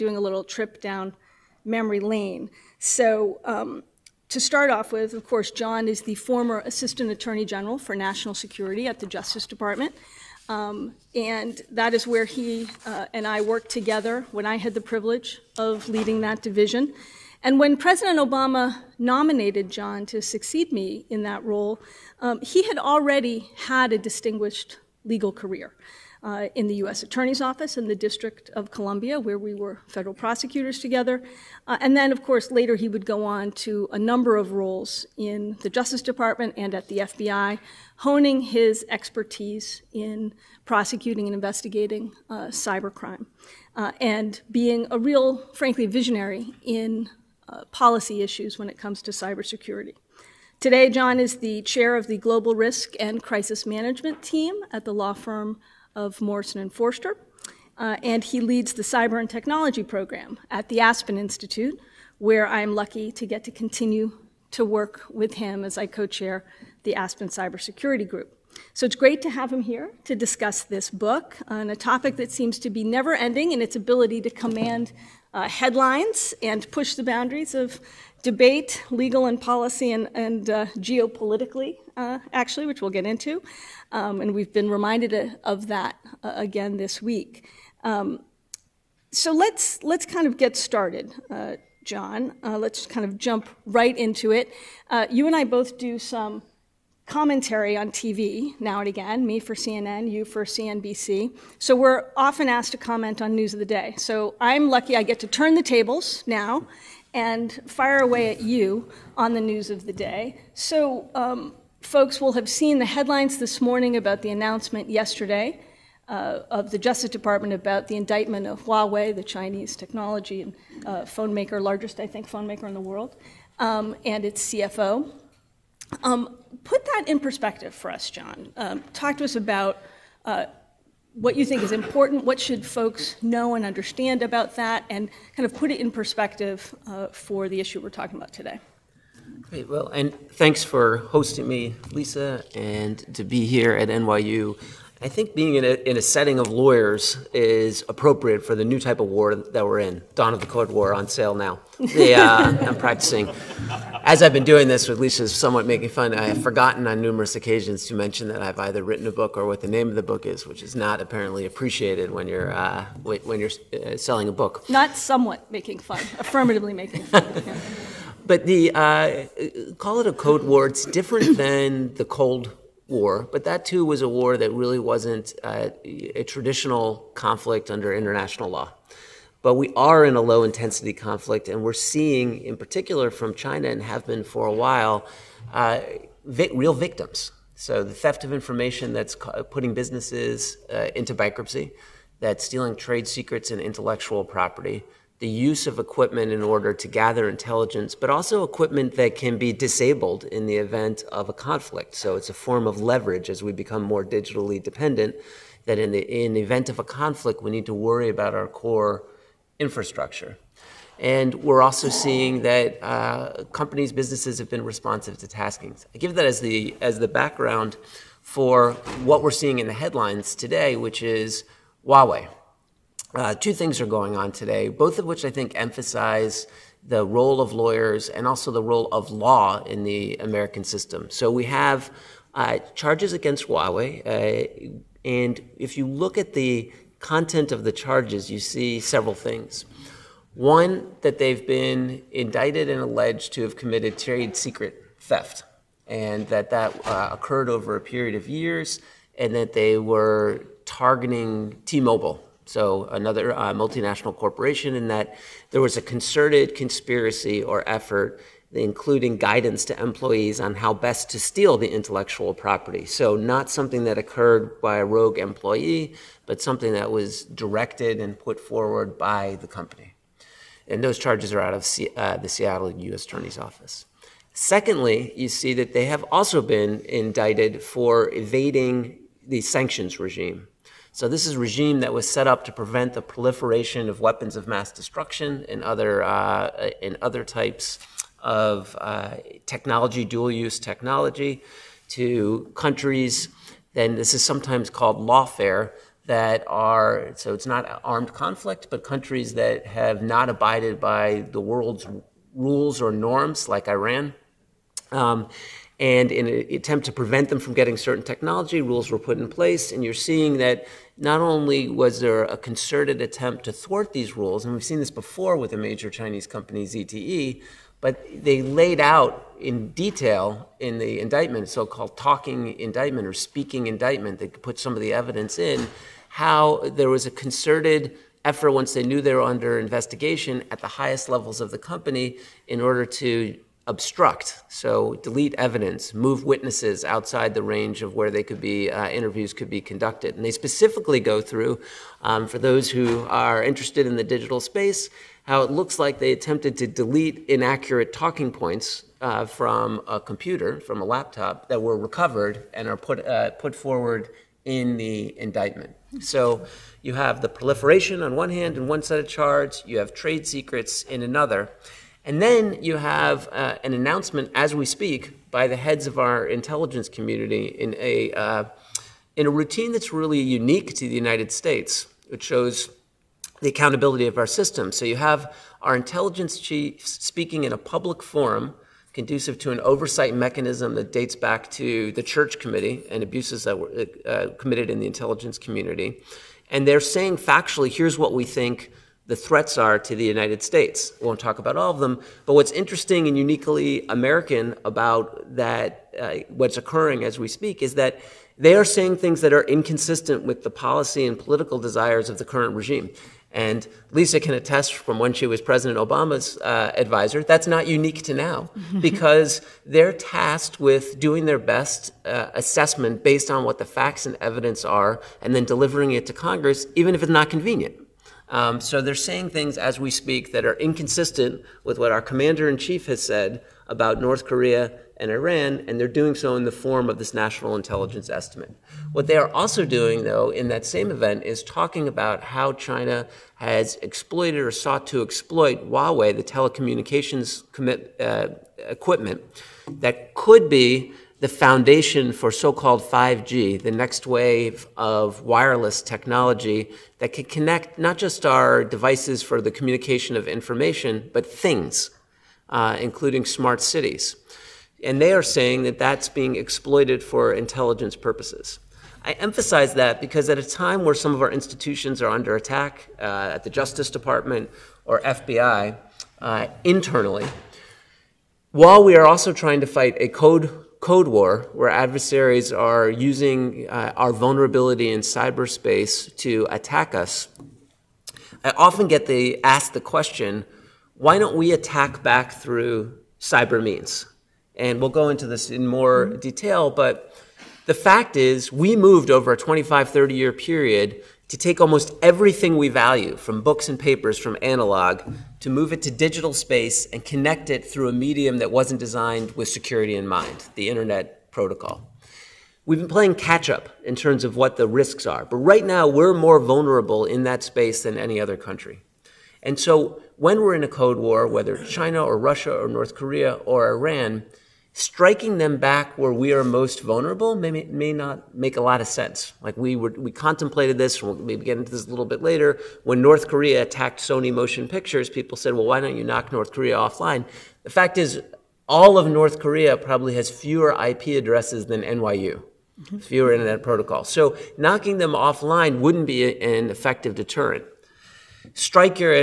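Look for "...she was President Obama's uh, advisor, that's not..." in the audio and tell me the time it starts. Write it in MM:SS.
06:45.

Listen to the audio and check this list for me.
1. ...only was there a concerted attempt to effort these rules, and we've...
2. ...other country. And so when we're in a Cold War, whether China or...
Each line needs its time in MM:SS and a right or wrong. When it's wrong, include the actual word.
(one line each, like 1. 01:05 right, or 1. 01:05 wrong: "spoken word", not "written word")
1. 05:11 wrong: "thwart", not "effort"
2. 08:28 right.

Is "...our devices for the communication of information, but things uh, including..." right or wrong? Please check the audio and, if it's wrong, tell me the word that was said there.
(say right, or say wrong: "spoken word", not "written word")
right.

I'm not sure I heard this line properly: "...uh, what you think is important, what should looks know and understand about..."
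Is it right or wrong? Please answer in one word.
wrong.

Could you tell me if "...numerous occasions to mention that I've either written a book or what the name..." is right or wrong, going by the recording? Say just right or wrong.
right.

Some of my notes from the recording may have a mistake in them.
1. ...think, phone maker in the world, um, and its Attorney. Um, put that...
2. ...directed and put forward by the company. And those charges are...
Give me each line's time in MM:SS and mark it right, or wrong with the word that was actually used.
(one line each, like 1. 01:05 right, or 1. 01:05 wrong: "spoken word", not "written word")
1. 02:02 wrong: "CFO", not "Attorney"
2. 04:27 right.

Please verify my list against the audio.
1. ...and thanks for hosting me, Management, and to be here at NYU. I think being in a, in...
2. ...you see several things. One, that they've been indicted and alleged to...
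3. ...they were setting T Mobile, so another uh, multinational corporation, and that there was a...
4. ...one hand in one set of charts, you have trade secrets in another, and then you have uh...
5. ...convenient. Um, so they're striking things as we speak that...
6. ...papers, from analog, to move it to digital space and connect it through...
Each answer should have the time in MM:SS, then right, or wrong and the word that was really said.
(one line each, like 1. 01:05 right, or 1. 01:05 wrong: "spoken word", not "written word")
1. 02:19 wrong: "Lisa", not "Management"
2. 03:58 right
3. 04:09 wrong: "targeting", not "setting"
4. 05:58 right
5. 06:57 wrong: "saying", not "striking"
6. 08:13 right.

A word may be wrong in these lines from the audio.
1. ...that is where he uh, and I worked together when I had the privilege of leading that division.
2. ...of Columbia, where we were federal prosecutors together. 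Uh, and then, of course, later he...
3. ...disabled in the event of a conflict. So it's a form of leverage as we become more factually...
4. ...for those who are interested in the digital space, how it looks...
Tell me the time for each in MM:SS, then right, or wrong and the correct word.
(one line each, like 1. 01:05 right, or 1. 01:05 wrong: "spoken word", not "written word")
1. 00:11 right
2. 00:28 right
3. 03:19 wrong: "digitally", not "factually"
4. 05:42 right.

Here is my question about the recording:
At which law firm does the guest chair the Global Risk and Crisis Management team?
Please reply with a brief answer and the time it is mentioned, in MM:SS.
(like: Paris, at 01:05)
Morrison and Foerster, at 00:56.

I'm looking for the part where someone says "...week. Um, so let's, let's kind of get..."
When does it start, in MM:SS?
01:27.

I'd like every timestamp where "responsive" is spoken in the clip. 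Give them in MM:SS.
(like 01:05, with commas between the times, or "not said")
03:34.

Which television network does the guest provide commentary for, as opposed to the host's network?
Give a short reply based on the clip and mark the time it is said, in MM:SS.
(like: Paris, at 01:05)
CNBC, at 01:40.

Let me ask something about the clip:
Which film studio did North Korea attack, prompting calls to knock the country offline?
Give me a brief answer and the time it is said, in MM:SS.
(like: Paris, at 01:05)
Sony Motion Pictures, at 08:43.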